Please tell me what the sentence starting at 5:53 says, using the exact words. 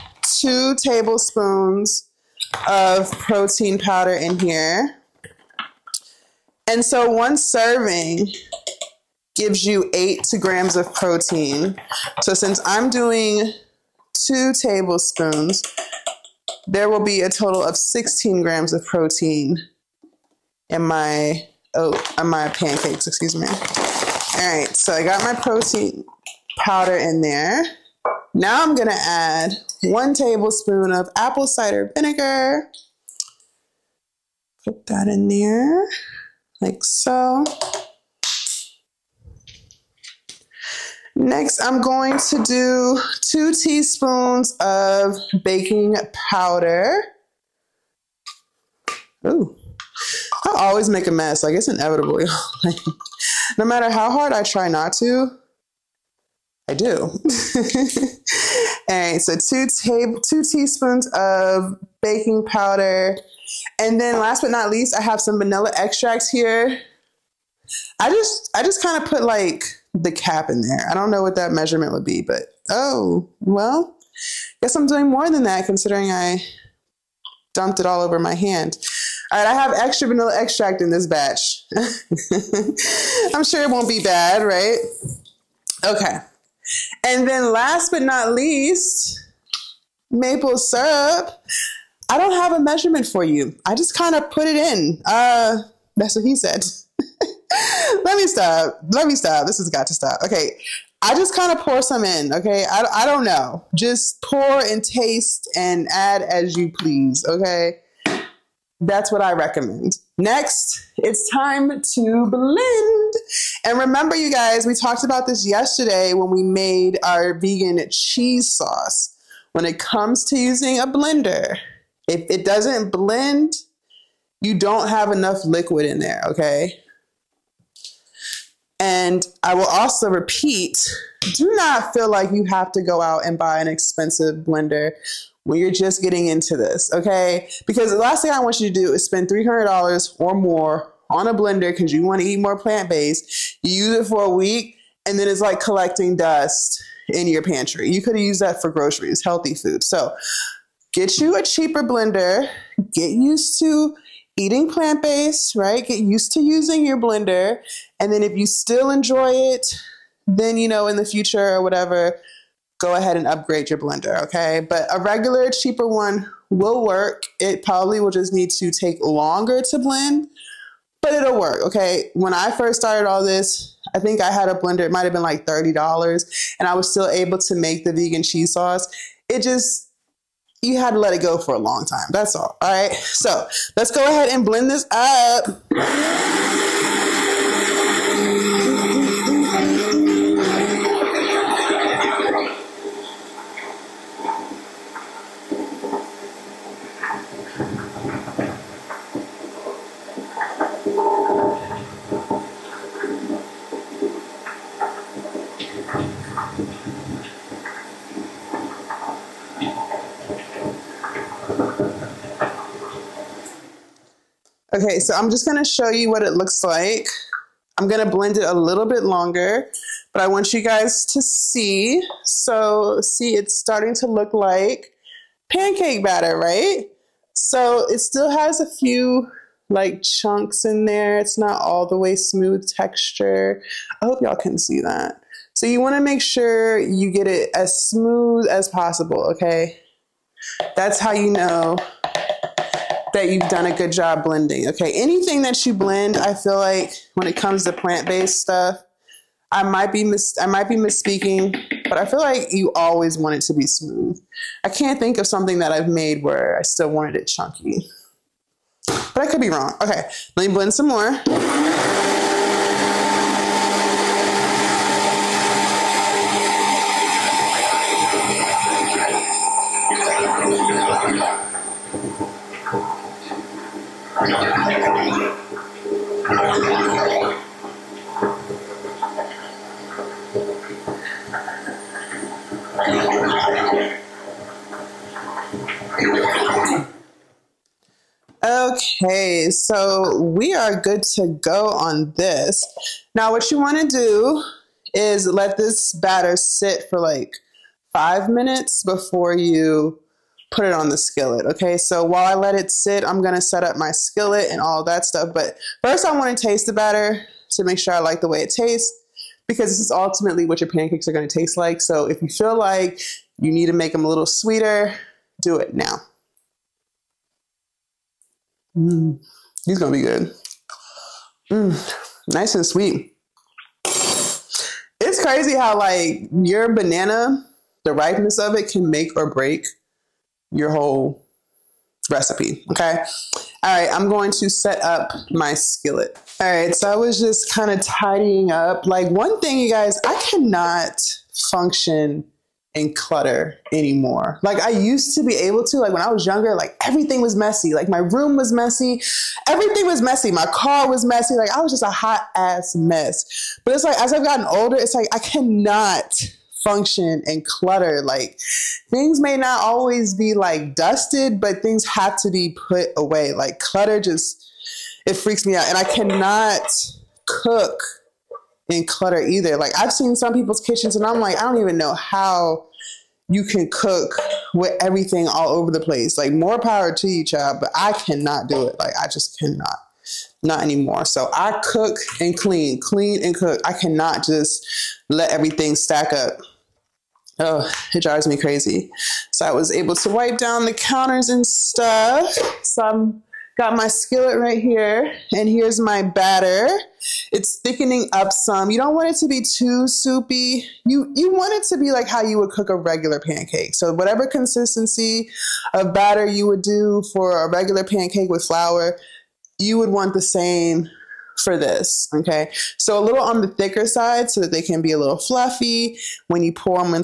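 But it's like, as I've gotten older, it's like, I cannot function and clutter.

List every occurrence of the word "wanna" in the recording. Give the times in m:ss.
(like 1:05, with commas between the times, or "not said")
5:06.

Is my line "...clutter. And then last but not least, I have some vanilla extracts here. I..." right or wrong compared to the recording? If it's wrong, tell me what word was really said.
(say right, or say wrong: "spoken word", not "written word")
wrong: "powder", not "clutter".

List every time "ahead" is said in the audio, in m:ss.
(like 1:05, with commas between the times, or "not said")
2:42, 3:04.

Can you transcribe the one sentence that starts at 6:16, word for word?
Like more power to you, child, but I cannot do it.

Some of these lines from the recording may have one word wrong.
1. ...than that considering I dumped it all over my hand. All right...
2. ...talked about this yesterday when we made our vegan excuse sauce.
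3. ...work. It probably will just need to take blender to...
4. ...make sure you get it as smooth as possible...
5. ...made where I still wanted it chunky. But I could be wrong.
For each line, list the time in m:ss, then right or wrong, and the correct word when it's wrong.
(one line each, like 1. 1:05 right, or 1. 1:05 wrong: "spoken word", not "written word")
1. 1:15 right
2. 1:54 wrong: "cheese", not "excuse"
3. 2:46 wrong: "longer", not "blender"
4. 3:56 right
5. 4:15 right.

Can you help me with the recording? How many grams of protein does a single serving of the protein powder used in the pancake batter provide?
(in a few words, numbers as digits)
8 grams.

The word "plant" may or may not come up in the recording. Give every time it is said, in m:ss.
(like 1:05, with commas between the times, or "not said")
2:22, 2:34, 4:07.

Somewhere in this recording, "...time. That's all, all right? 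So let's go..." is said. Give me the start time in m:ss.
3:01.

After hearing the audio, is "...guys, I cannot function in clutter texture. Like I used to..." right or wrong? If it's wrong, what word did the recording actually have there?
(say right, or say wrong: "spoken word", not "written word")
wrong: "anymore", not "texture".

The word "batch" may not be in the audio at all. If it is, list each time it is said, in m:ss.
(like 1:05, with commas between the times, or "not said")
1:21.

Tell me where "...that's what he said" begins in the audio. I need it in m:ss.
1:35.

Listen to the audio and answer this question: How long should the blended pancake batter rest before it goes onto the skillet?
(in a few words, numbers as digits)
5 minutes.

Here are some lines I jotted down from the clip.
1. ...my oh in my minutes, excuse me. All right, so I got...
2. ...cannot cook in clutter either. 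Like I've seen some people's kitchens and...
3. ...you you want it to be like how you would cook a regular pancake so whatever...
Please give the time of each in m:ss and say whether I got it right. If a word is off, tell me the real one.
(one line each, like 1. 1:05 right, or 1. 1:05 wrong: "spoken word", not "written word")
1. 0:20 wrong: "pancakes", not "minutes"
2. 6:05 right
3. 6:40 right.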